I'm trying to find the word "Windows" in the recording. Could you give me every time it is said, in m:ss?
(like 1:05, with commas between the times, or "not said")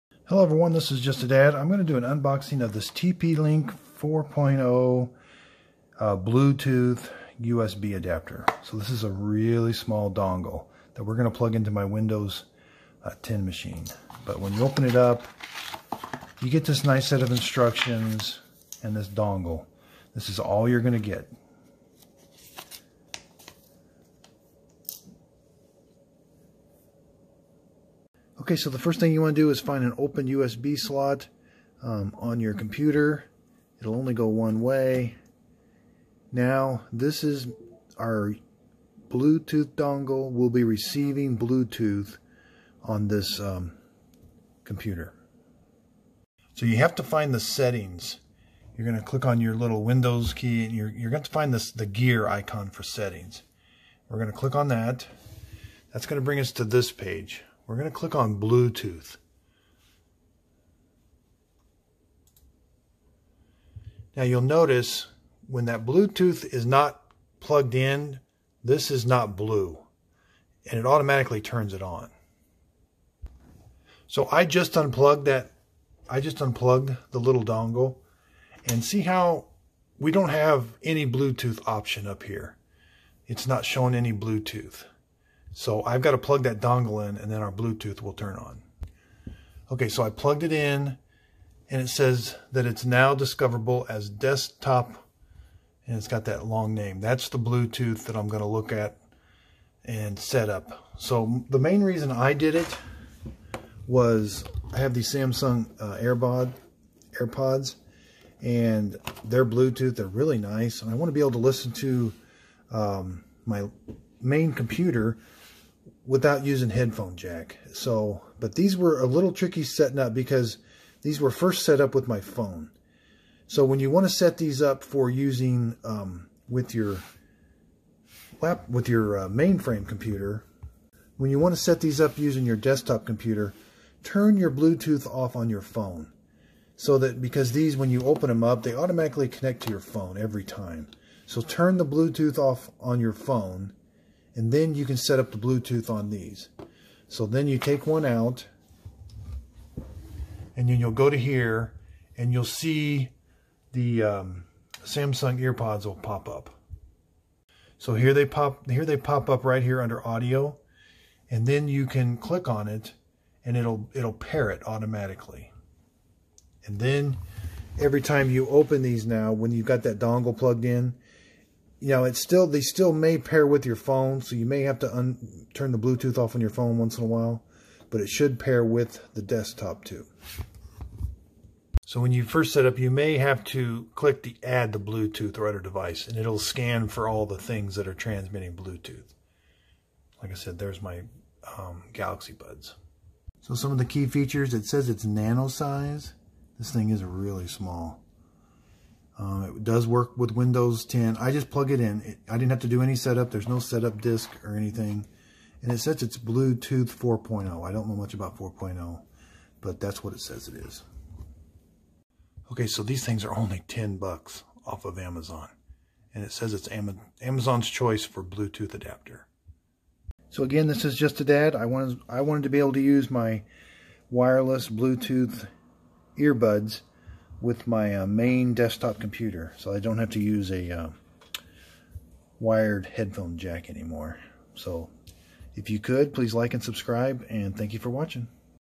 0:11, 0:49, 3:20.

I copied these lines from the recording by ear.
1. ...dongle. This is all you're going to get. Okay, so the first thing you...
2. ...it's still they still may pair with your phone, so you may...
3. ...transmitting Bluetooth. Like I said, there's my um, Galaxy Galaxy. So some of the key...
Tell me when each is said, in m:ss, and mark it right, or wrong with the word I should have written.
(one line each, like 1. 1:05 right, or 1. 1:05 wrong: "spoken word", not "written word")
1. 0:19 right
2. 2:52 right
3. 3:07 wrong: "Buds", not "Galaxy".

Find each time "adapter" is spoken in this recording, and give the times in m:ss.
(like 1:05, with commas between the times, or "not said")
0:07, 3:38.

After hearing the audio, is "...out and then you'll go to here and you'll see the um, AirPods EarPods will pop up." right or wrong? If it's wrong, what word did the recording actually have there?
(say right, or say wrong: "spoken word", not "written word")
wrong: "Samsung", not "AirPods".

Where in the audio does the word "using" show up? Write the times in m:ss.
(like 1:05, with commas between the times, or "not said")
1:56, 2:05, 2:12.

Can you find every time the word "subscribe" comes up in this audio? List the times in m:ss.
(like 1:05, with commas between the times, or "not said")
3:56.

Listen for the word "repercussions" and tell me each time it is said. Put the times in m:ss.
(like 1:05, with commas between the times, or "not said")
not said.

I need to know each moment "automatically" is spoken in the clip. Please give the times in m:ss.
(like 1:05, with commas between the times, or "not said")
1:10, 2:18, 2:44.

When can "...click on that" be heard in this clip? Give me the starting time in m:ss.
0:54.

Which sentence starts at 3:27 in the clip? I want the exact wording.
I don't know much about 4.0, but that's what it says it is.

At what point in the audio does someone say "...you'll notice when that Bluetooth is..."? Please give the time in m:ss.
1:04.